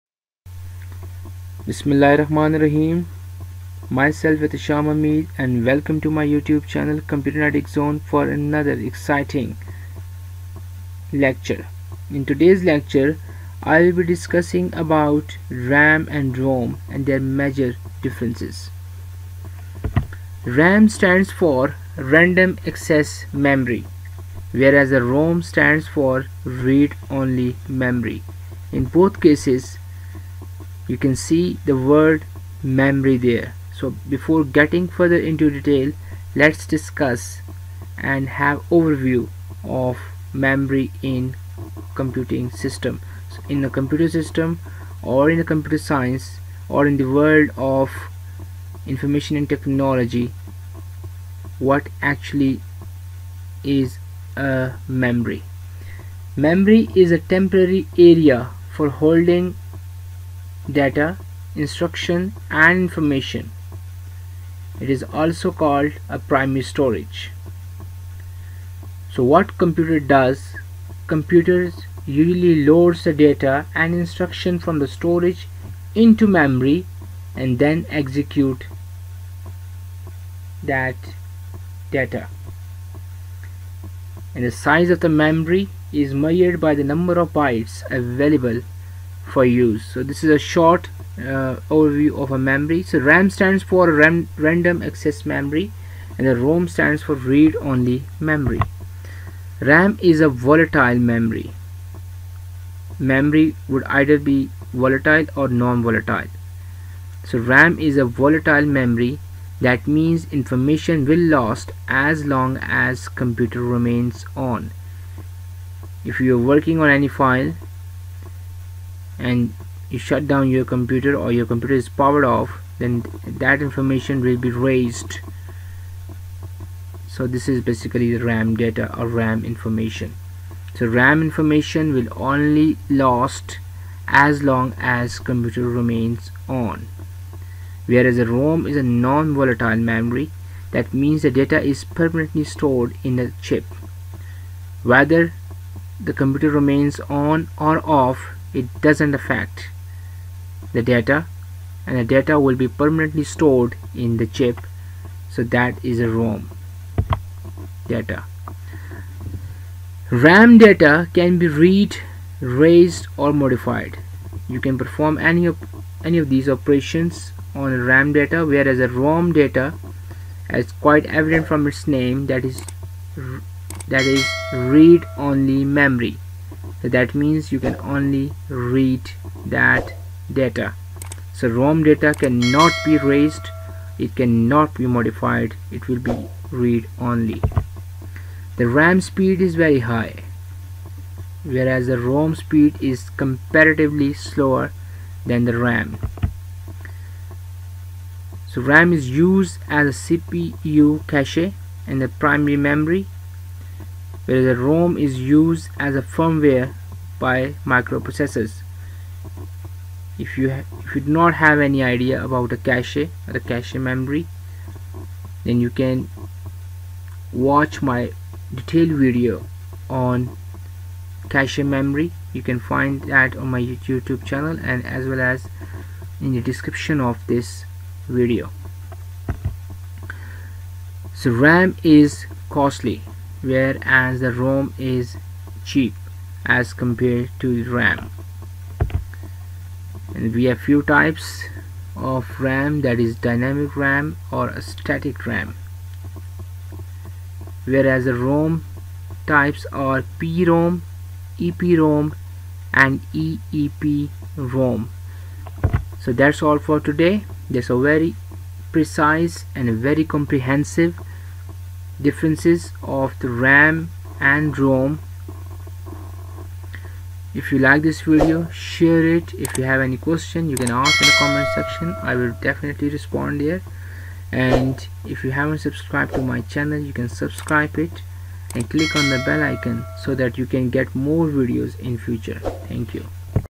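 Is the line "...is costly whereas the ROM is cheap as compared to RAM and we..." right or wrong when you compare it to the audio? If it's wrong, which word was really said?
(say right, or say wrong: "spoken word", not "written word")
right.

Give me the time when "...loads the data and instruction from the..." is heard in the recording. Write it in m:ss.
1:12.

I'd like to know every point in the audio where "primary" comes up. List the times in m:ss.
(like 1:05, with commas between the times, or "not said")
1:06, 3:22.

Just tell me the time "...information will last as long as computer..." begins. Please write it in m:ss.
1:50.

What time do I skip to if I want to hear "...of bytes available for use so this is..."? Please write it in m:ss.
1:27.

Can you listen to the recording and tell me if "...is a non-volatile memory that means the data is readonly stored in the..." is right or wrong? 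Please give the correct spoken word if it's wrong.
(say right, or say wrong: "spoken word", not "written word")
wrong: "permanently", not "readonly".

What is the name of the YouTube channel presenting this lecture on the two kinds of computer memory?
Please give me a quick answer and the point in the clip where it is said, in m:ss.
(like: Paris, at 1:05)
Computer Zone, at 0:07.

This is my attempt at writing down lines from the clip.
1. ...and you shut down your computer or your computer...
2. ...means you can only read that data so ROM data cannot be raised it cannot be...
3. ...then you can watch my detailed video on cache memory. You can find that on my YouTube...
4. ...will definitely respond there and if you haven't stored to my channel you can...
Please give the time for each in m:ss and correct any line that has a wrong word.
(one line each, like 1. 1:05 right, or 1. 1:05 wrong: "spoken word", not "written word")
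1. 1:59 right
2. 2:57 right
3. 3:35 right
4. 4:32 wrong: "subscribed", not "stored".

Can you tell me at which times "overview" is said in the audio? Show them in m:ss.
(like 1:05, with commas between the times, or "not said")
0:38, 1:31.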